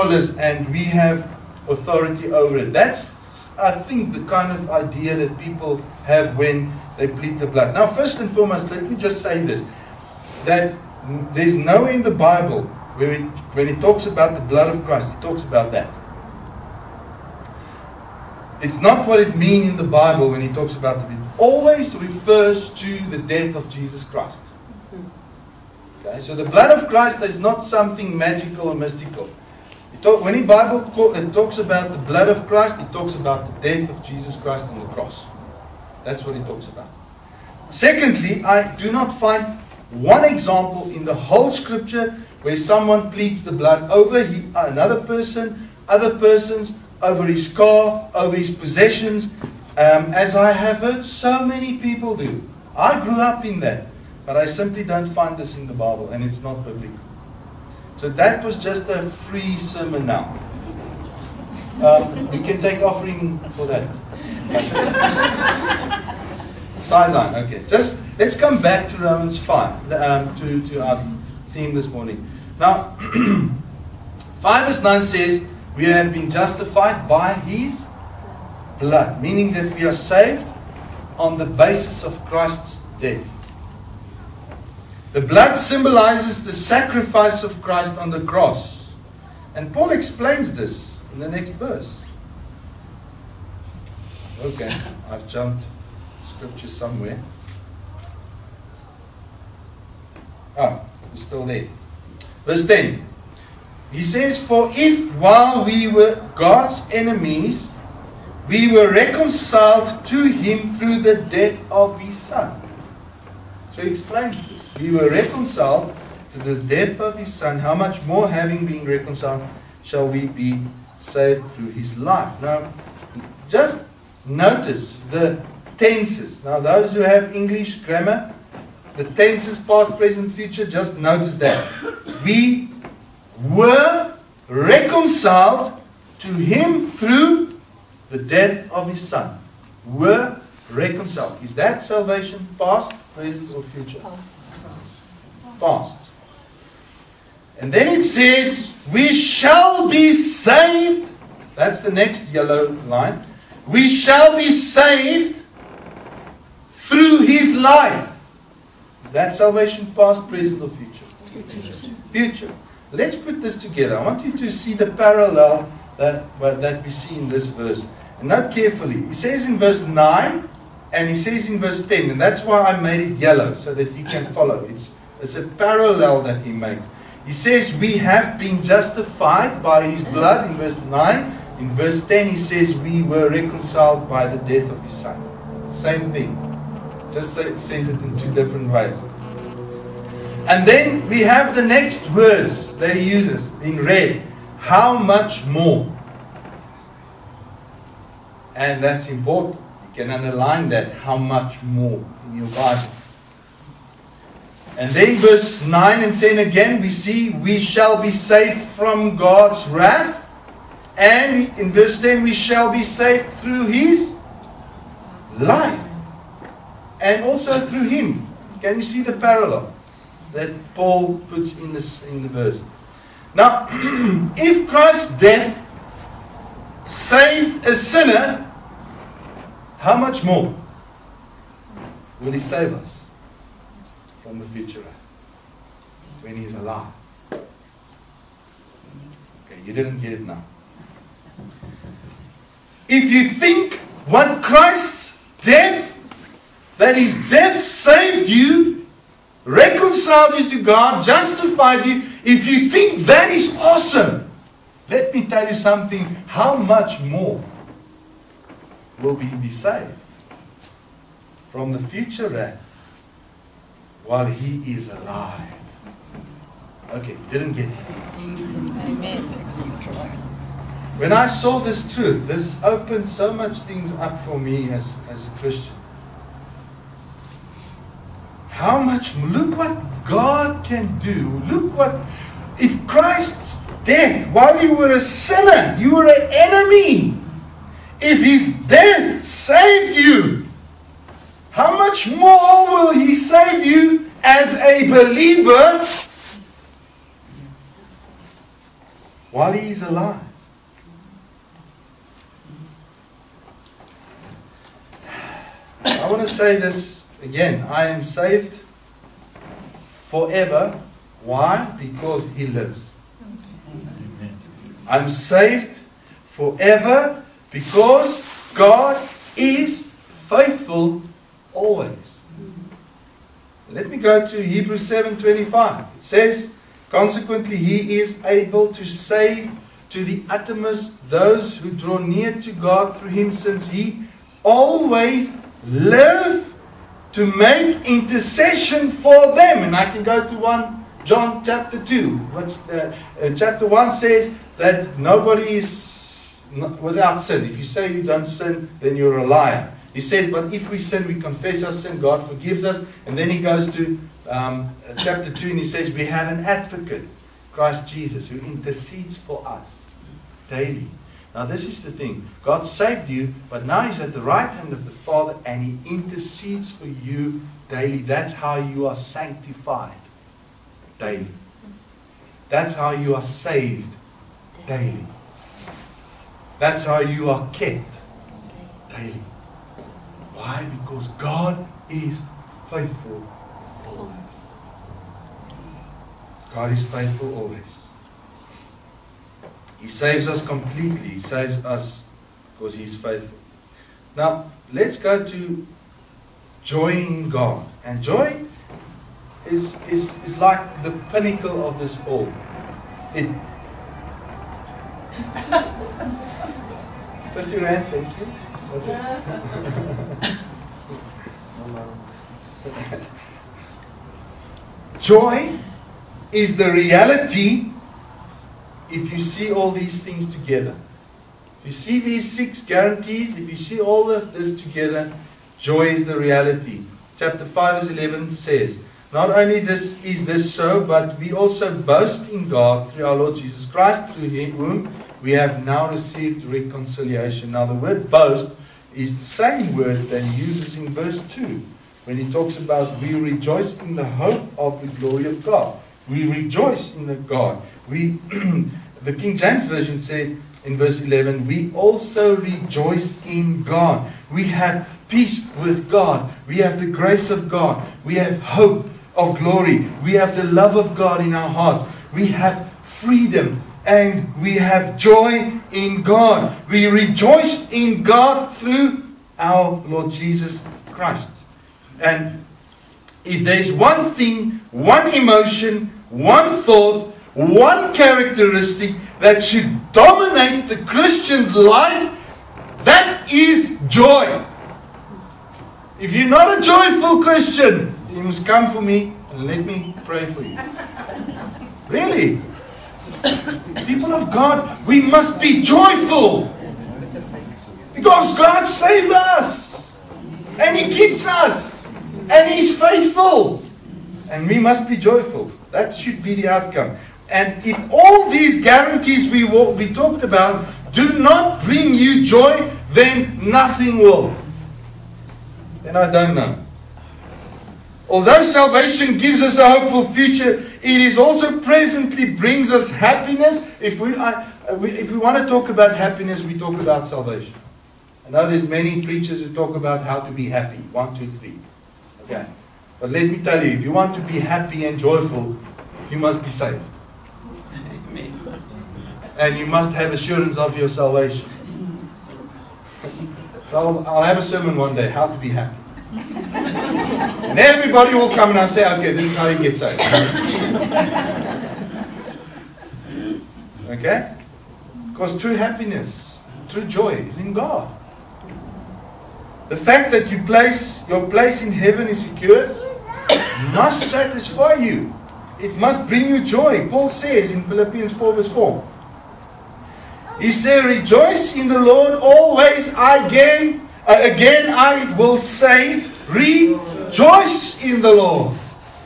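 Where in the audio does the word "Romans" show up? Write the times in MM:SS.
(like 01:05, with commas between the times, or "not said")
01:08.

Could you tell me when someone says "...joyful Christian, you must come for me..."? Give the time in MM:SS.
08:06.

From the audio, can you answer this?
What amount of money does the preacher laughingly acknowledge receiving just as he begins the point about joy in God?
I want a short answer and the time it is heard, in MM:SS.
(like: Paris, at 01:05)
50 Rand, at 06:47.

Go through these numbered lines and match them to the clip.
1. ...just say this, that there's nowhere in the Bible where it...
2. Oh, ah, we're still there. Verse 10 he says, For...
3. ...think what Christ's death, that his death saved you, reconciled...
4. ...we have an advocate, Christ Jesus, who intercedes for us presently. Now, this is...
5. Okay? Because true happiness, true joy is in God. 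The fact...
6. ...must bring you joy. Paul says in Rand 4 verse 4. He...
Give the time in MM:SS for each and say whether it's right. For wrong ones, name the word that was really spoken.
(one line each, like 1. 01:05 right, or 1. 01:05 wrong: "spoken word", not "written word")
1. 00:08 right
2. 01:40 right
3. 04:03 right
4. 05:55 wrong: "daily", not "presently"
5. 09:13 right
6. 09:25 wrong: "Philippians", not "Rand".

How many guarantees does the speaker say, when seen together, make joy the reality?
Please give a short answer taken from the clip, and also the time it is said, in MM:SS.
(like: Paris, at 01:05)
6, at 07:02.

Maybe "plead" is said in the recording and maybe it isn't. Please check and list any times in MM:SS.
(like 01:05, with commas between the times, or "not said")
00:07, 00:43.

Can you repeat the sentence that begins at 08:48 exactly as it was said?
I know there's many preachers who talk about how to be happy.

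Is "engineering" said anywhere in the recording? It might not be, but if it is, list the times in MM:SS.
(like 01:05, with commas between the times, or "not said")
not said.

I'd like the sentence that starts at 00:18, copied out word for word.
It's not what it means in the Bible when he talks about the people.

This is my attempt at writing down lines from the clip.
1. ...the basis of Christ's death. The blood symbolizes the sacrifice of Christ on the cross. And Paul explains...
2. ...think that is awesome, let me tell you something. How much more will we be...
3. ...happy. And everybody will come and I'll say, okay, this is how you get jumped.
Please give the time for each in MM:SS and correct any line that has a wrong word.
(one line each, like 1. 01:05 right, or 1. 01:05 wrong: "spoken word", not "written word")
1. 01:21 right
2. 04:12 right
3. 09:05 wrong: "saved", not "jumped".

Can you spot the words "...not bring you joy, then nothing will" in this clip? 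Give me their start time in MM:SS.
08:31.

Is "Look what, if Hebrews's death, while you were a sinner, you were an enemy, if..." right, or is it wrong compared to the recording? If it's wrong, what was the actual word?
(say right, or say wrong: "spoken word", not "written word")
wrong: "Christ", not "Hebrews".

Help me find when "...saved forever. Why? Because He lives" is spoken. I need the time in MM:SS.
05:08.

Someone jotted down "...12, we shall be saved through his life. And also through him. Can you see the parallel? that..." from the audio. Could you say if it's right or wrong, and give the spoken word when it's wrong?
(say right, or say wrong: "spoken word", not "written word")
wrong: "10", not "12".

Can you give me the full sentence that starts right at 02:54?
It's, it's a parallel that he makes.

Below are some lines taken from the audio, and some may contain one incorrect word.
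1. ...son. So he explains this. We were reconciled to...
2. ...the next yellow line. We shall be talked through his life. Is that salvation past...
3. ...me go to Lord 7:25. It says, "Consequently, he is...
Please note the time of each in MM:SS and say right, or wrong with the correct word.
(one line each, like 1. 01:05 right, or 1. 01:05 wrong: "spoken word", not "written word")
1. 01:52 right
2. 02:31 wrong: "saved", not "talked"
3. 05:23 wrong: "Hebrews", not "Lord".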